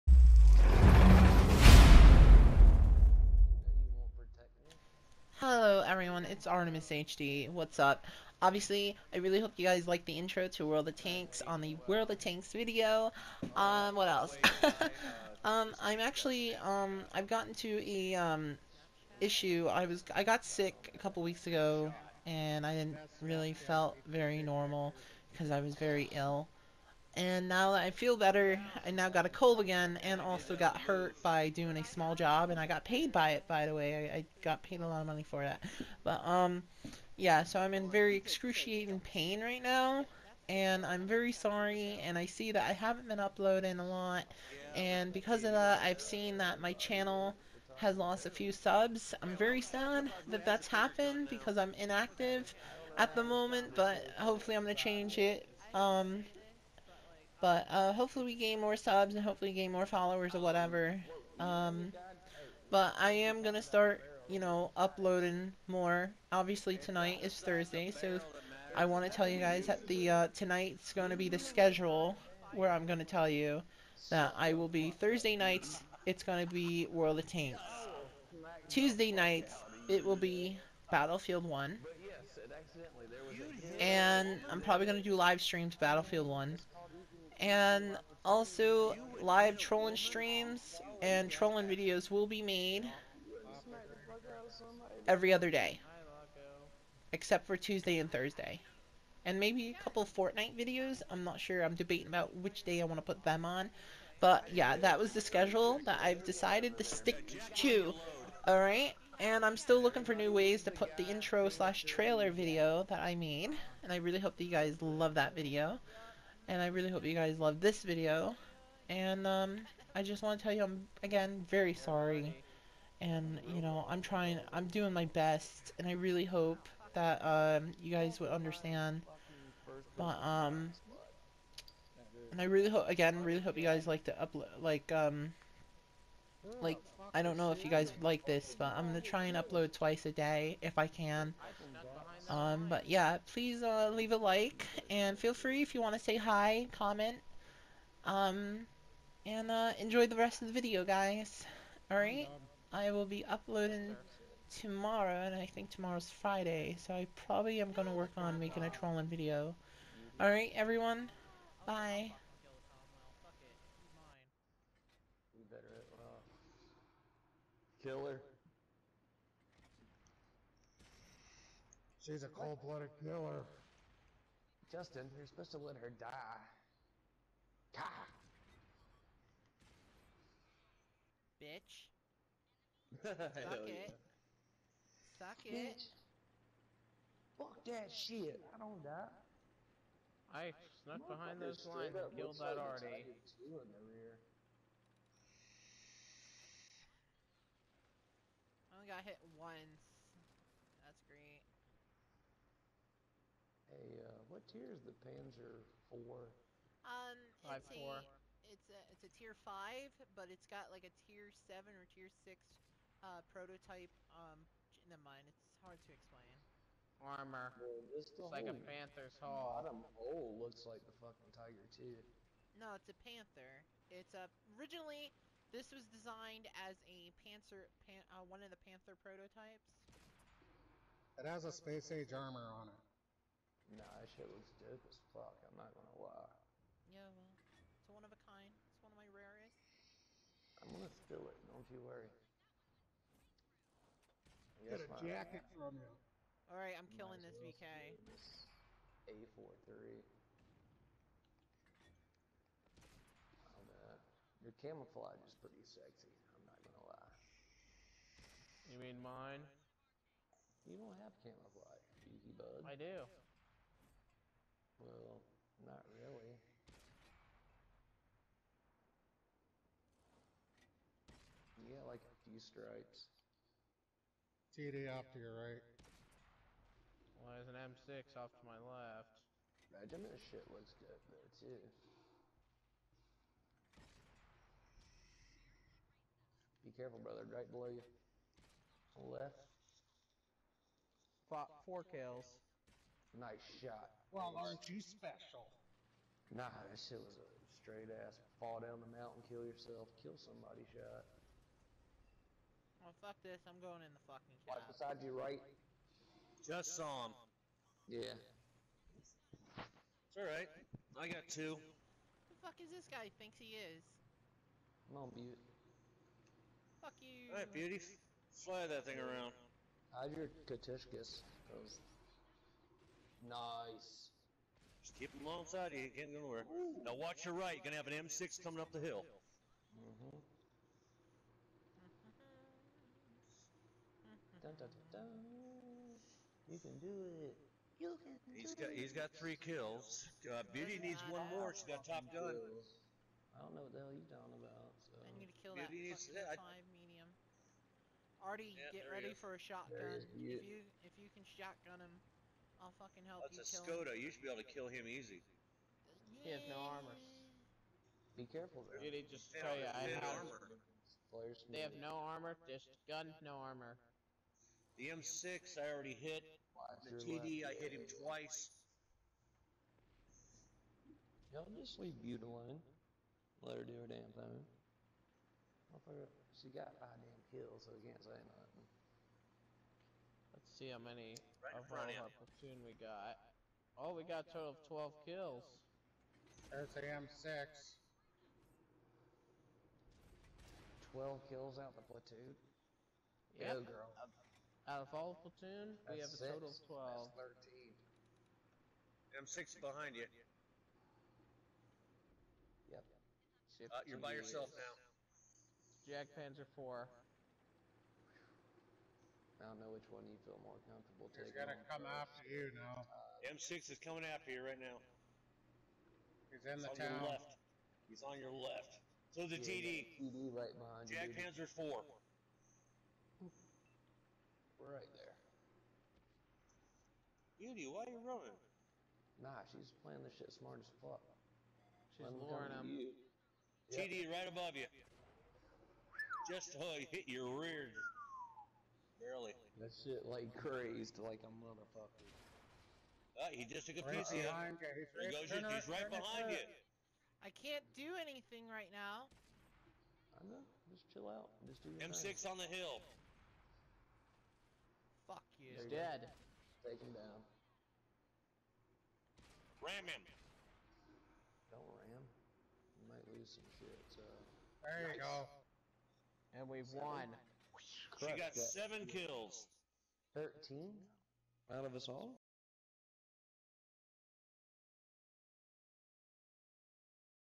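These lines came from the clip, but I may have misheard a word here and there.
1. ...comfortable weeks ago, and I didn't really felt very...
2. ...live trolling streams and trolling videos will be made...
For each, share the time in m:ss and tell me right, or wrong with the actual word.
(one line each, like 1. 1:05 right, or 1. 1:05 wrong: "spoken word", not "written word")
1. 0:20 wrong: "couple", not "comfortable"
2. 1:29 right.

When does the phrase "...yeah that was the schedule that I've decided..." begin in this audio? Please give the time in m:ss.
1:44.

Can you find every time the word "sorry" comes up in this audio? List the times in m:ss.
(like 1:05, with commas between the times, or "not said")
0:41, 2:01.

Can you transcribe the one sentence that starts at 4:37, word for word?
Well, there's an M6 off to my left.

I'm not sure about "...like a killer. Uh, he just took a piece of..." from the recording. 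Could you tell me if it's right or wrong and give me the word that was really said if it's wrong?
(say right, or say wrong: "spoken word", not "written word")
wrong: "motherfucker", not "killer".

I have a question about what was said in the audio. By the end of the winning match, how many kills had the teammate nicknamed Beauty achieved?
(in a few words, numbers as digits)
7.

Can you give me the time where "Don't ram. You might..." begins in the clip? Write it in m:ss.
7:41.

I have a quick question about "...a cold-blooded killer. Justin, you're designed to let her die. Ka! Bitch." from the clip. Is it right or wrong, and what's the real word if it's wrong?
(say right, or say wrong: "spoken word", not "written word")
wrong: "supposed", not "designed".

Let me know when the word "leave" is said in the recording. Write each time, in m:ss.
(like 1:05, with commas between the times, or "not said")
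2:23, 6:11.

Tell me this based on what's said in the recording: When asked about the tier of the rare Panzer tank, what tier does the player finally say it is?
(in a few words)
tier 5.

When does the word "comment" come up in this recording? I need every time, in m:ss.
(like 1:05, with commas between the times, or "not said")
2:26.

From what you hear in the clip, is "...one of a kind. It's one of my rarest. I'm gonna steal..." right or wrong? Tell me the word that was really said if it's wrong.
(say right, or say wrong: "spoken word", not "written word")
right.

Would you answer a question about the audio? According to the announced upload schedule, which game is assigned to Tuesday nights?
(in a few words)
Battlefield 1.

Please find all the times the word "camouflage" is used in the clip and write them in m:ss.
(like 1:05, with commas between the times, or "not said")
4:14, 4:21.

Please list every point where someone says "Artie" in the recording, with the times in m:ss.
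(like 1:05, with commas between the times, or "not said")
3:12, 5:48.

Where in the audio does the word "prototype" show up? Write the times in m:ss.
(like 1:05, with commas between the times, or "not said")
3:33, 3:49.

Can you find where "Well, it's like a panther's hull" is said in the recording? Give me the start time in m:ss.
3:37.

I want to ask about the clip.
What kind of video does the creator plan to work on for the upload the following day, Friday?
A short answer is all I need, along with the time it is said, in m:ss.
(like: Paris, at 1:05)
trolling video, at 2:38.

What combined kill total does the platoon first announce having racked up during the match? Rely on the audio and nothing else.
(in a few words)
12.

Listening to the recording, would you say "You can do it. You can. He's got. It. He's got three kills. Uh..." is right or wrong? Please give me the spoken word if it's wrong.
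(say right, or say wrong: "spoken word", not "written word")
right.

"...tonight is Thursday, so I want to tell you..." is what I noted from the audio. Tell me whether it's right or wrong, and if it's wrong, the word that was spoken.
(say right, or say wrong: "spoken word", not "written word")
right.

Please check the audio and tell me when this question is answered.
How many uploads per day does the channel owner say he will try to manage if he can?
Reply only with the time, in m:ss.
2:19.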